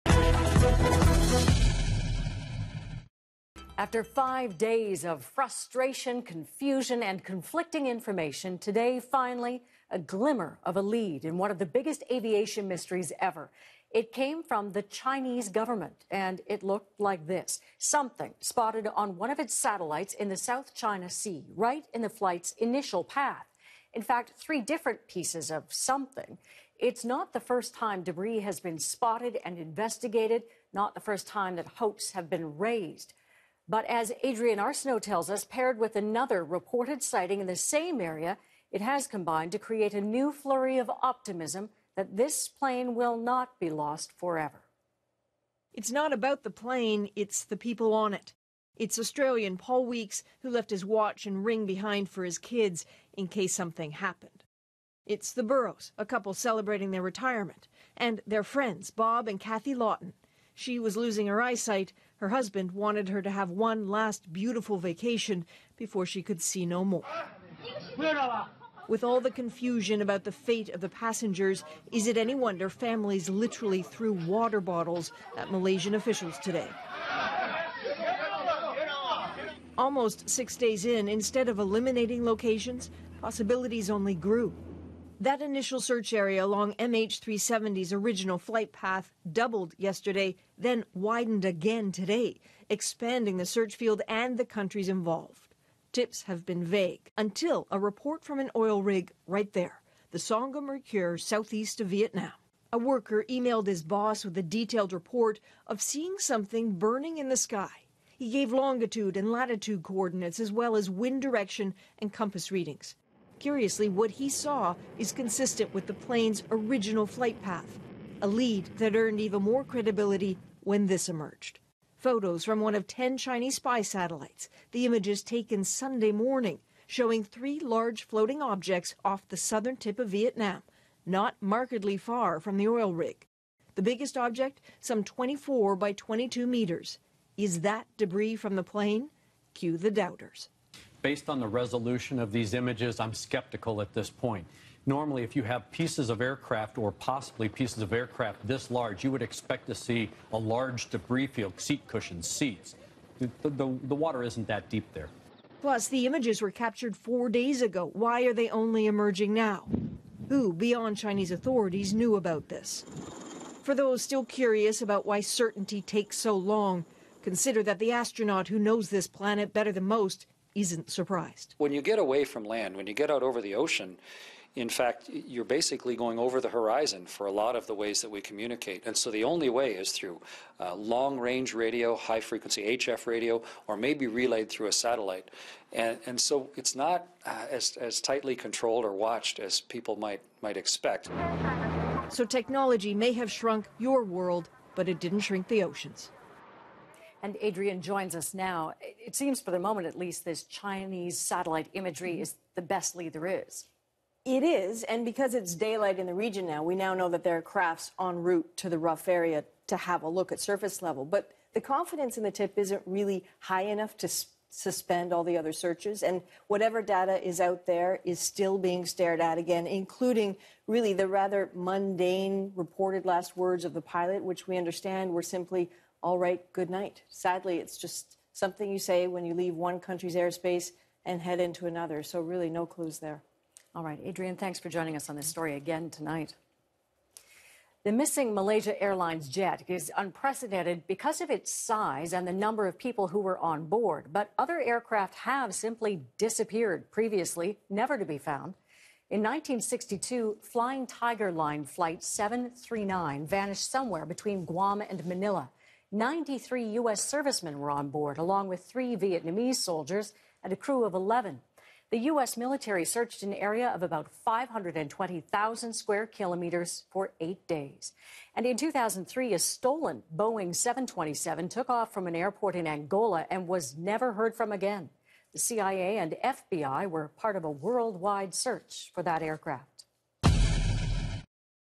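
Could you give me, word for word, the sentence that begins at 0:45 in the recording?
It's not about the plane, it's the people on it.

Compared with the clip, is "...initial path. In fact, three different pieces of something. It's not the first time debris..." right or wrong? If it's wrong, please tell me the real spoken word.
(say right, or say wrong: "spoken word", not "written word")
right.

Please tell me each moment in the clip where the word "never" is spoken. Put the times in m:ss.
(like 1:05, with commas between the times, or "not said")
4:07, 4:33.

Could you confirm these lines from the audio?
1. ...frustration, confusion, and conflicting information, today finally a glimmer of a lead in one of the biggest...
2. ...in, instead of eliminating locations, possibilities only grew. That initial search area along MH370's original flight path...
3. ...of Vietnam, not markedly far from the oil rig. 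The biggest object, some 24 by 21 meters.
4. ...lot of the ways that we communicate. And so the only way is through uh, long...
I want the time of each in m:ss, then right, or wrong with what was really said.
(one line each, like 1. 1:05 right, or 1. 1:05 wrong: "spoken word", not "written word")
1. 0:05 right
2. 1:20 right
3. 2:09 wrong: "22", not "21"
4. 2:57 right.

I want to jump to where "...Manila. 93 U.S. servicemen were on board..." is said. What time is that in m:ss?
4:15.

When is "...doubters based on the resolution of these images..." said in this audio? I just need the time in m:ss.
2:19.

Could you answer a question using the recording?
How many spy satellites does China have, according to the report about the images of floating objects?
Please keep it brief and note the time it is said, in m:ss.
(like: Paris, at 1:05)
10, at 2:02.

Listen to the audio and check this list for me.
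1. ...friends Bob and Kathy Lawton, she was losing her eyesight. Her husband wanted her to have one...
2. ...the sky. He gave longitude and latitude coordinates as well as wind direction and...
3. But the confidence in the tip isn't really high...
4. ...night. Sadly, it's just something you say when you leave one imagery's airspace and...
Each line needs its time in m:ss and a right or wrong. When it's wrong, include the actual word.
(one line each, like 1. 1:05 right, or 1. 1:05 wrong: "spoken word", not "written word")
1. 0:58 right
2. 1:47 right
3. 3:31 right
4. 3:46 wrong: "country", not "imagery".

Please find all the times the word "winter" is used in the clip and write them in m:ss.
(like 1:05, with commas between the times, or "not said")
not said.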